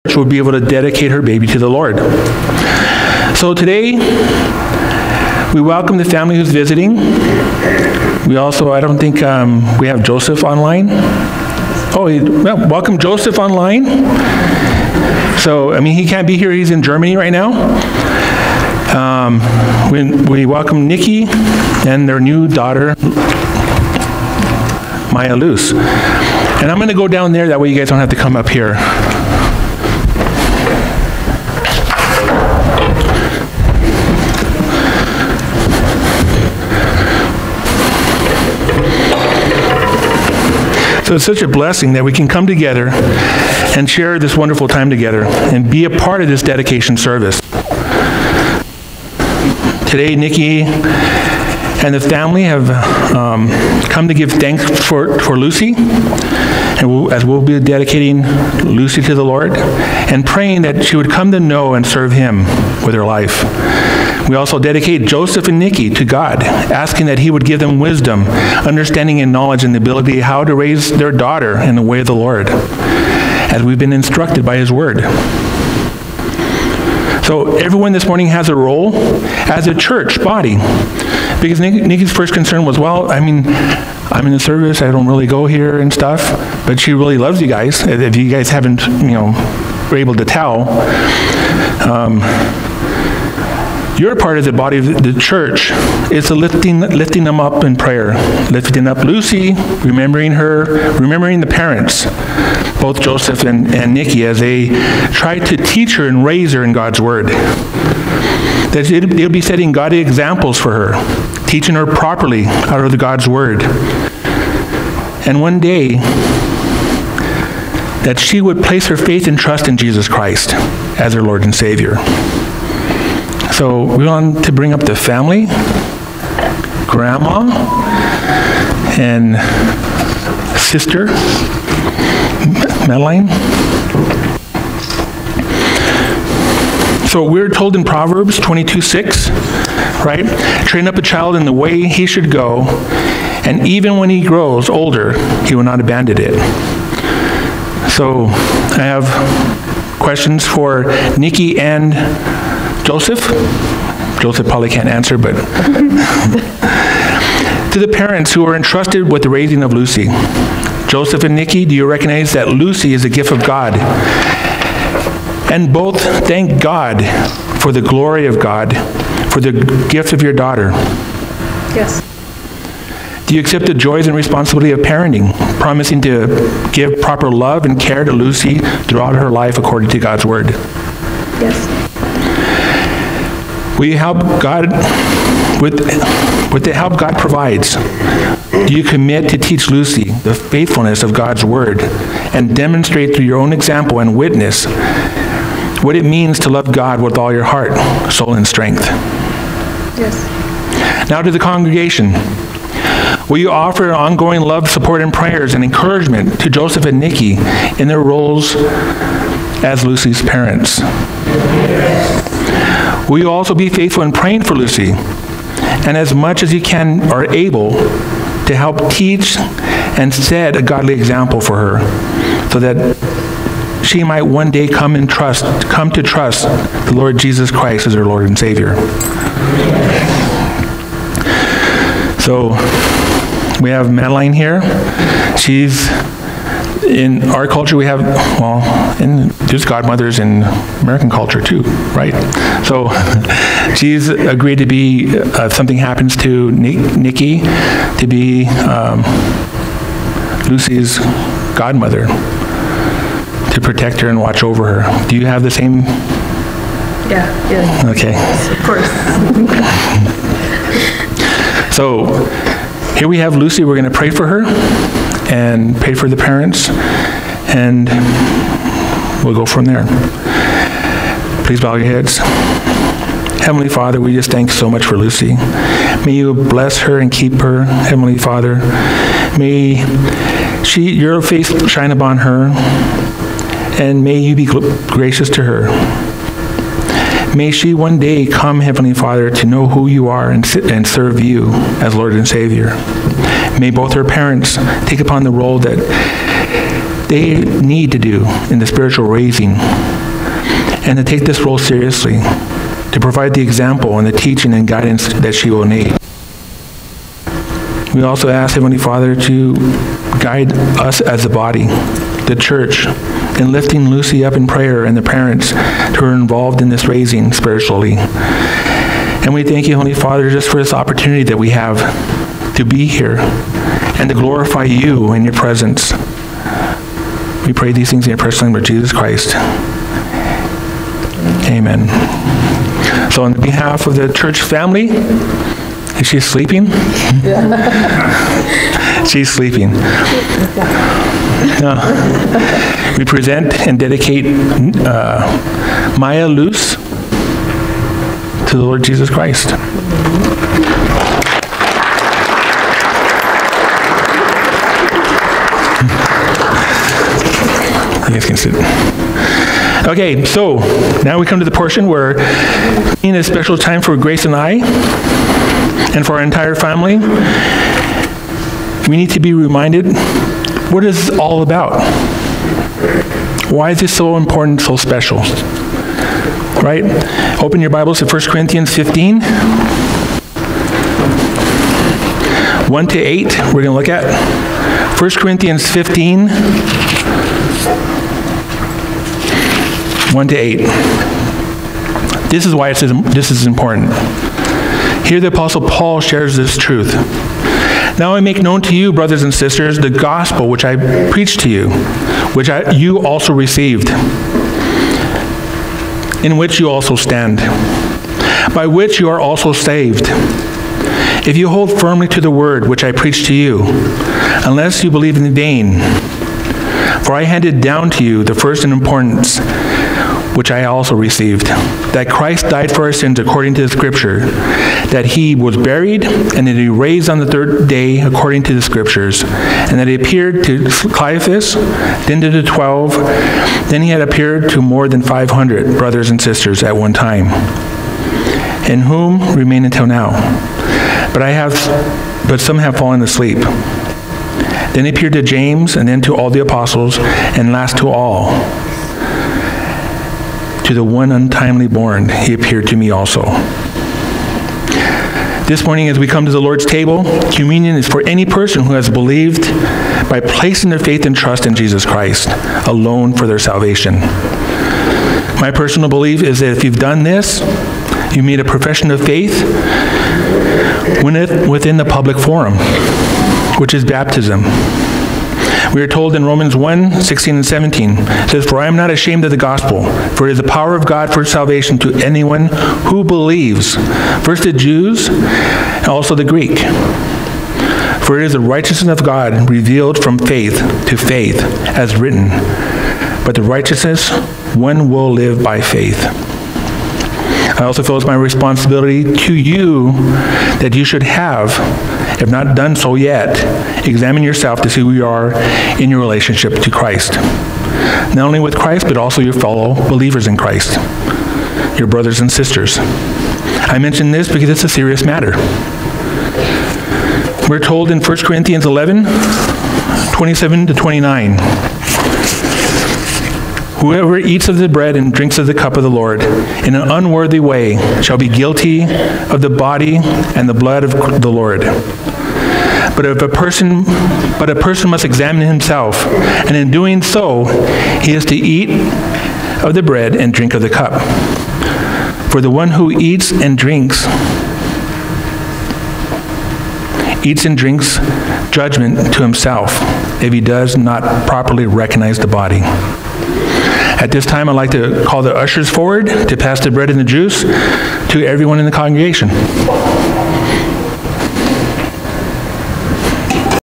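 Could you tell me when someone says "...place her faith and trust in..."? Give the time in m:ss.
1:58.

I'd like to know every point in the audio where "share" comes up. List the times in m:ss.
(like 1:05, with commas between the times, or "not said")
0:43, 6:36.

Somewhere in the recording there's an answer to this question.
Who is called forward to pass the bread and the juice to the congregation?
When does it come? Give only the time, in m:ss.
9:15.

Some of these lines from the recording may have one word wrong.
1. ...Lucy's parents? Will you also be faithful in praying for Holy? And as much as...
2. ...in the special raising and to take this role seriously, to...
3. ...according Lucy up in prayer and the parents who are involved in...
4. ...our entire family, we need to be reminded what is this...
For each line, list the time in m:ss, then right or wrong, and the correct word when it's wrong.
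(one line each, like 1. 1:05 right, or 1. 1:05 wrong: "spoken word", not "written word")
1. 3:29 wrong: "Lucy", not "Holy"
2. 4:58 wrong: "spiritual", not "special"
3. 5:13 wrong: "lifting", not "according"
4. 6:06 right.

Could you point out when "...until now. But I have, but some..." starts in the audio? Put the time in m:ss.
7:19.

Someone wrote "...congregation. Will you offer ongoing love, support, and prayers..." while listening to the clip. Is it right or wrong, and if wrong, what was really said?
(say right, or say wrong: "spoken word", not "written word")
right.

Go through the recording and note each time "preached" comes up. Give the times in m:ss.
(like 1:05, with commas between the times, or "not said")
6:41, 6:52.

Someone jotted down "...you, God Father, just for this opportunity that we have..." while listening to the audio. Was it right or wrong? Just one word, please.
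wrong.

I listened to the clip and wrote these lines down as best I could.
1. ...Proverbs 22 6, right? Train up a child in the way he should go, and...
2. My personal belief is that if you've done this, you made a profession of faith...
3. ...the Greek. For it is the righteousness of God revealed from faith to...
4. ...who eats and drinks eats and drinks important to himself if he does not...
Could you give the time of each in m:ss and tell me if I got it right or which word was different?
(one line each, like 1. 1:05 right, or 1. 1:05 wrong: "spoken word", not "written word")
1. 2:17 right
2. 7:45 right
3. 8:06 right
4. 9:02 wrong: "judgment", not "important".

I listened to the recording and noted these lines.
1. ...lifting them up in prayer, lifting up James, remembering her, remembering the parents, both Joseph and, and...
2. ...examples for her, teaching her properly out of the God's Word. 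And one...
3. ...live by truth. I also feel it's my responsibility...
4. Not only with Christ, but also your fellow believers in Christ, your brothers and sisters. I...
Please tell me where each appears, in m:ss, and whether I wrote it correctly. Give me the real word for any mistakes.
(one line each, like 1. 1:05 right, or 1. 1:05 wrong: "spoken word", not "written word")
1. 1:36 wrong: "Lucy", not "James"
2. 1:49 right
3. 8:15 wrong: "faith", not "truth"
4. 8:28 right.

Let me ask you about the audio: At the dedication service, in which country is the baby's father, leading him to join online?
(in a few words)
Germany.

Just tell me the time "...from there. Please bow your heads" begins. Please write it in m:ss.
4:29.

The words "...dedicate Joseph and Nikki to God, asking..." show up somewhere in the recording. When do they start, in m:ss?
1:04.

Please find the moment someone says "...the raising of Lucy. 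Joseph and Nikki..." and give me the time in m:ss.
2:39.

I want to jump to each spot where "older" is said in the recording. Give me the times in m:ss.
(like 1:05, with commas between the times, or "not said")
2:24.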